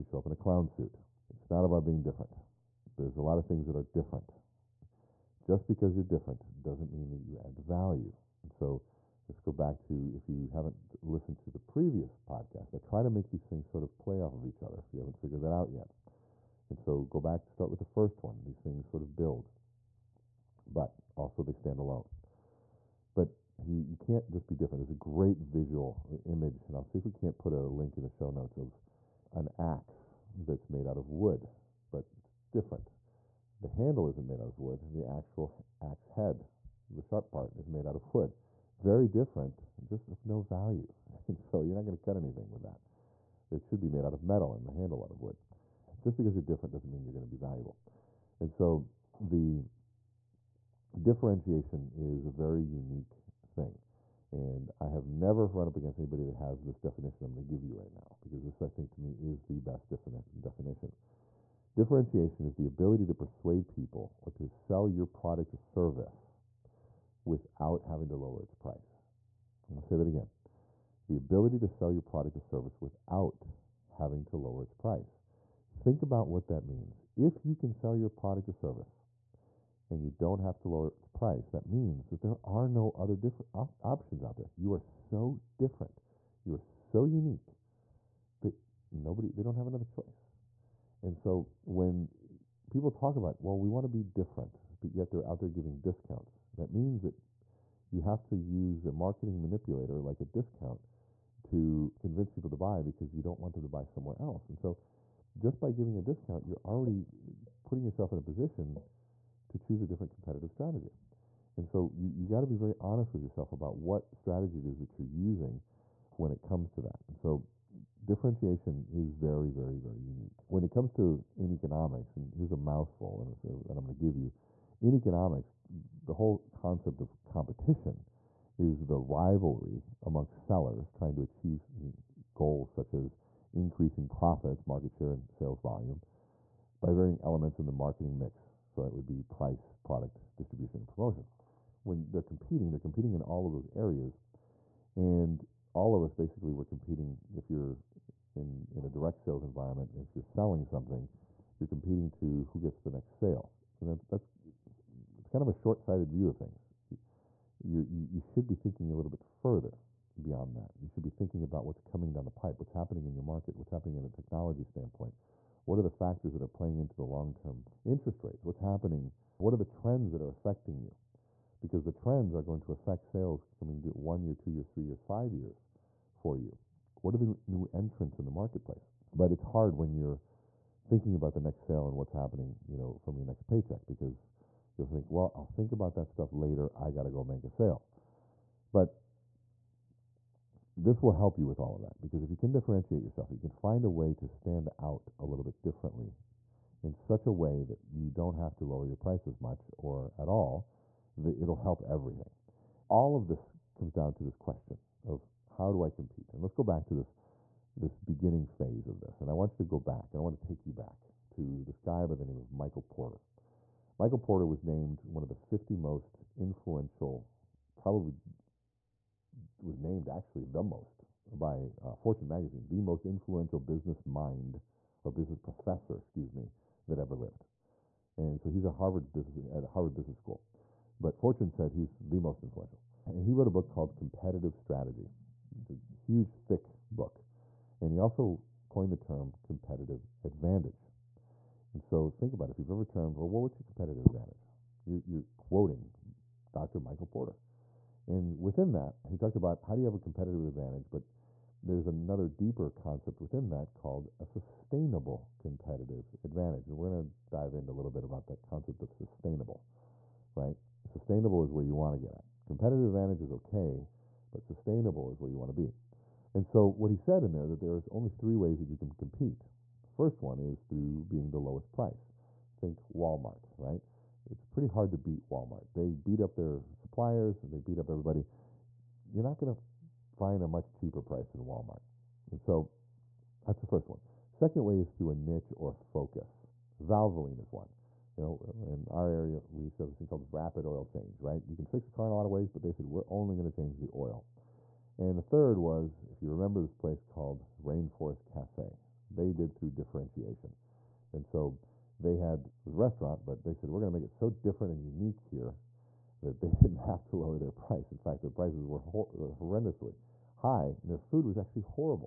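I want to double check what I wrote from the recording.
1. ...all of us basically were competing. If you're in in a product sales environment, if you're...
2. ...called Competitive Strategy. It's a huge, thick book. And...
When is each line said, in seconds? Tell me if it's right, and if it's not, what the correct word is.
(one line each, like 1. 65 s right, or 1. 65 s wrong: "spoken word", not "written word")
1. 145 s wrong: "direct", not "product"
2. 233 s right.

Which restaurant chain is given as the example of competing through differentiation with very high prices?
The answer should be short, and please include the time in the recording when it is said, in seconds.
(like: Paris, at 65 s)
Rainforest Cafe, at 297 s.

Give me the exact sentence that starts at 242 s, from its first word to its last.
If you've ever turned, well, what's your competitive advantage?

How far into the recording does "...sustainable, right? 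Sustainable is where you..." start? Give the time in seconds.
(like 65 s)
258 s.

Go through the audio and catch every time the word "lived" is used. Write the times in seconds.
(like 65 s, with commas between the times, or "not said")
227 s.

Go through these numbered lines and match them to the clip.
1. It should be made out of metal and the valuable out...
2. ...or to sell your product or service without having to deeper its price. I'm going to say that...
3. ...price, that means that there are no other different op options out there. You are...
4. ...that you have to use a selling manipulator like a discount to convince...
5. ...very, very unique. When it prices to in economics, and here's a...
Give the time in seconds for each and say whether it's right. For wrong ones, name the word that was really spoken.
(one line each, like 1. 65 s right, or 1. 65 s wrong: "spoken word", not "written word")
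1. 43 s wrong: "handle", not "valuable"
2. 64 s wrong: "lower", not "deeper"
3. 81 s right
4. 97 s wrong: "marketing", not "selling"
5. 119 s wrong: "comes", not "prices".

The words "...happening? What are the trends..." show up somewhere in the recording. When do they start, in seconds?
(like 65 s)
168 s.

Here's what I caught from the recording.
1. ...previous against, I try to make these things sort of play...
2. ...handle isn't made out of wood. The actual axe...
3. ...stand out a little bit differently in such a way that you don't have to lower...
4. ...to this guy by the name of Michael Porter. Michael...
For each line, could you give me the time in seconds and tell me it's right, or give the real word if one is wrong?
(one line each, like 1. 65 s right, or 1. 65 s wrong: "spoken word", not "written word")
1. 11 s wrong: "podcast", not "against"
2. 33 s right
3. 194 s right
4. 211 s right.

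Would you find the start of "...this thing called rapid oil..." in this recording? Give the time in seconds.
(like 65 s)
289 s.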